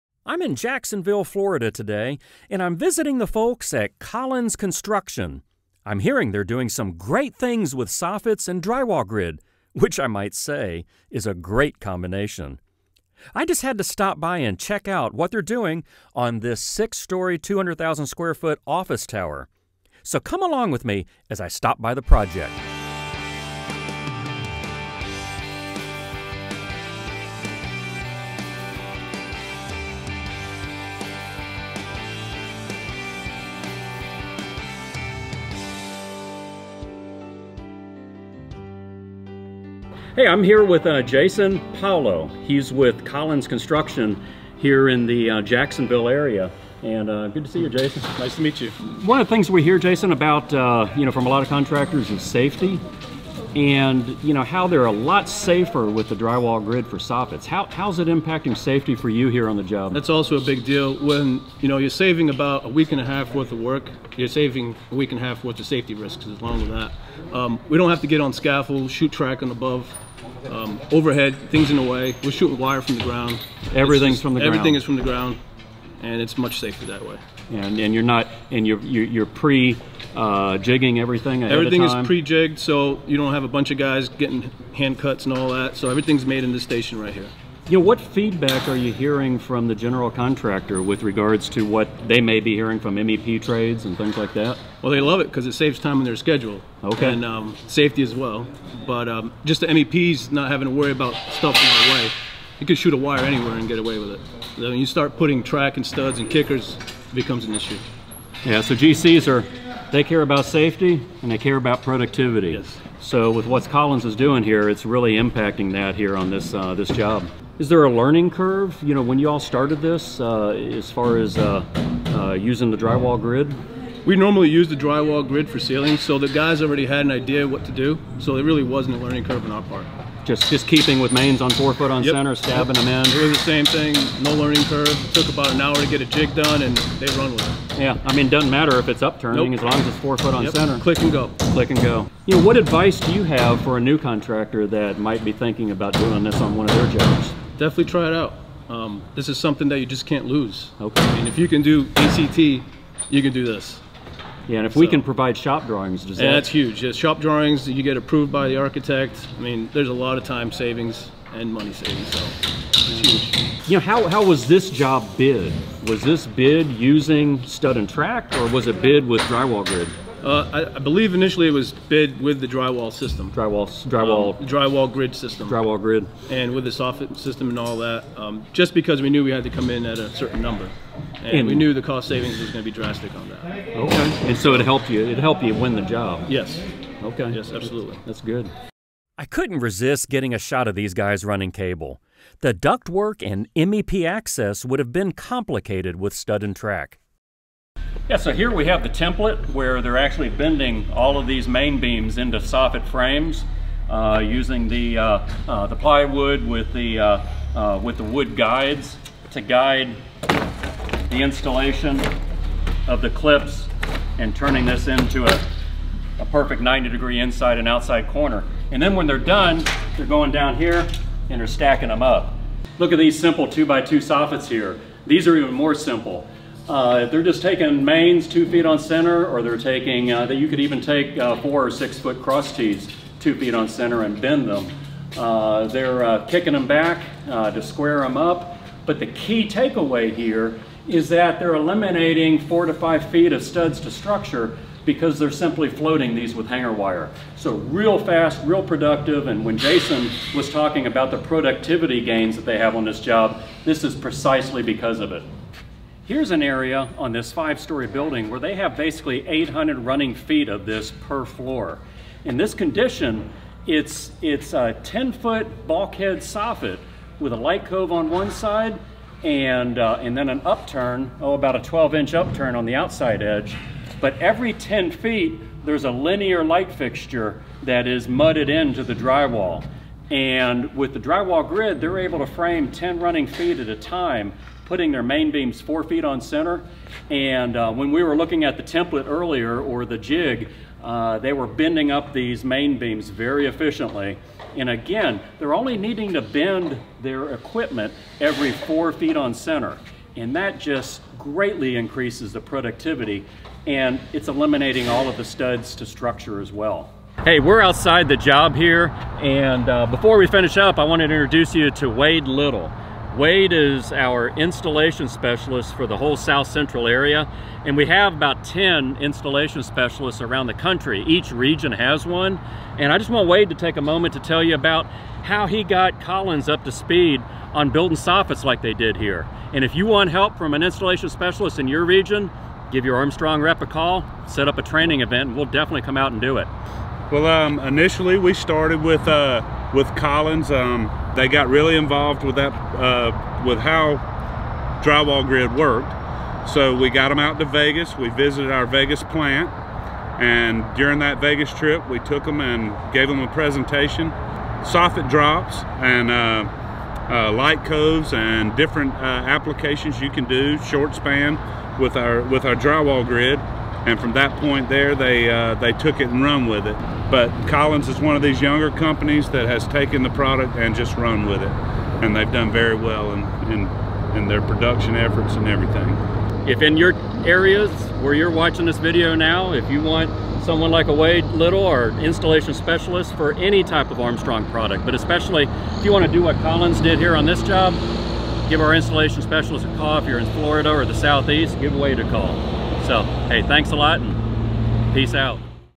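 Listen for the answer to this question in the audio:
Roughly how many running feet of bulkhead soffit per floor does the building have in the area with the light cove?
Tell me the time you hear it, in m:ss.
4:19.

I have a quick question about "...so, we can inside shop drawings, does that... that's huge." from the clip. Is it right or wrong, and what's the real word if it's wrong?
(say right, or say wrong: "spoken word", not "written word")
wrong: "provide", not "inside".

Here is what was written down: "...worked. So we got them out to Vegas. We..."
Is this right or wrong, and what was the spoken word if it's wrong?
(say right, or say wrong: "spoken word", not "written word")
right.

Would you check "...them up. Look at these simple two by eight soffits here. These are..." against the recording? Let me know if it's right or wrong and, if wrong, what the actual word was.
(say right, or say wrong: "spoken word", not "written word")
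wrong: "two", not "eight".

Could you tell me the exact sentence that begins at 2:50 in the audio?
Uh, I, I, believe initially it was bid with the drywall system.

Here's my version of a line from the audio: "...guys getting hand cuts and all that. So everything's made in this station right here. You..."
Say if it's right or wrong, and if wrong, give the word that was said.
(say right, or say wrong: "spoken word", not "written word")
right.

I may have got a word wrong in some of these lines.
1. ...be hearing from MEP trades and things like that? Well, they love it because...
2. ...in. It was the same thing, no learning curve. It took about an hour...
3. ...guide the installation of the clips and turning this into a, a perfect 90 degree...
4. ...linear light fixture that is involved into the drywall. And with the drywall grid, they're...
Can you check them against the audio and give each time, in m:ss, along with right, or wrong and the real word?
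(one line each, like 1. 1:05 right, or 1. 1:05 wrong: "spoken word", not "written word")
1. 1:32 right
2. 2:13 right
3. 3:29 right
4. 4:35 wrong: "mudded", not "involved".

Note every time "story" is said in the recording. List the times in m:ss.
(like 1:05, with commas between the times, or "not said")
0:16, 4:17.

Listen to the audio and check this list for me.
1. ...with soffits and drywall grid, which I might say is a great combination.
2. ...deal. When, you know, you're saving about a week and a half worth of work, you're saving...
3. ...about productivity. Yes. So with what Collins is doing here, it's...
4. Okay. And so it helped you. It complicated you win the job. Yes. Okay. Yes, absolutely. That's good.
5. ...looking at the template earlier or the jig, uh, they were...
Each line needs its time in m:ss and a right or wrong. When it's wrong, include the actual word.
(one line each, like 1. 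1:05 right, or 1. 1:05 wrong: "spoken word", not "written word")
1. 0:07 right
2. 1:00 right
3. 1:51 right
4. 3:03 wrong: "helped", not "complicated"
5. 4:48 right.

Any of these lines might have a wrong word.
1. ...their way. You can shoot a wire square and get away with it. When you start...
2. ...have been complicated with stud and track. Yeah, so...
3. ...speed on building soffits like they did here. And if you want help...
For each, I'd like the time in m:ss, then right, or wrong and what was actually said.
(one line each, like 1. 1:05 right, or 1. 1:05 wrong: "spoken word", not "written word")
1. 1:41 wrong: "anywhere", not "square"
2. 3:14 right
3. 5:26 right.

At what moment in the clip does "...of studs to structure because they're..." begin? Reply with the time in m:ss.
4:03.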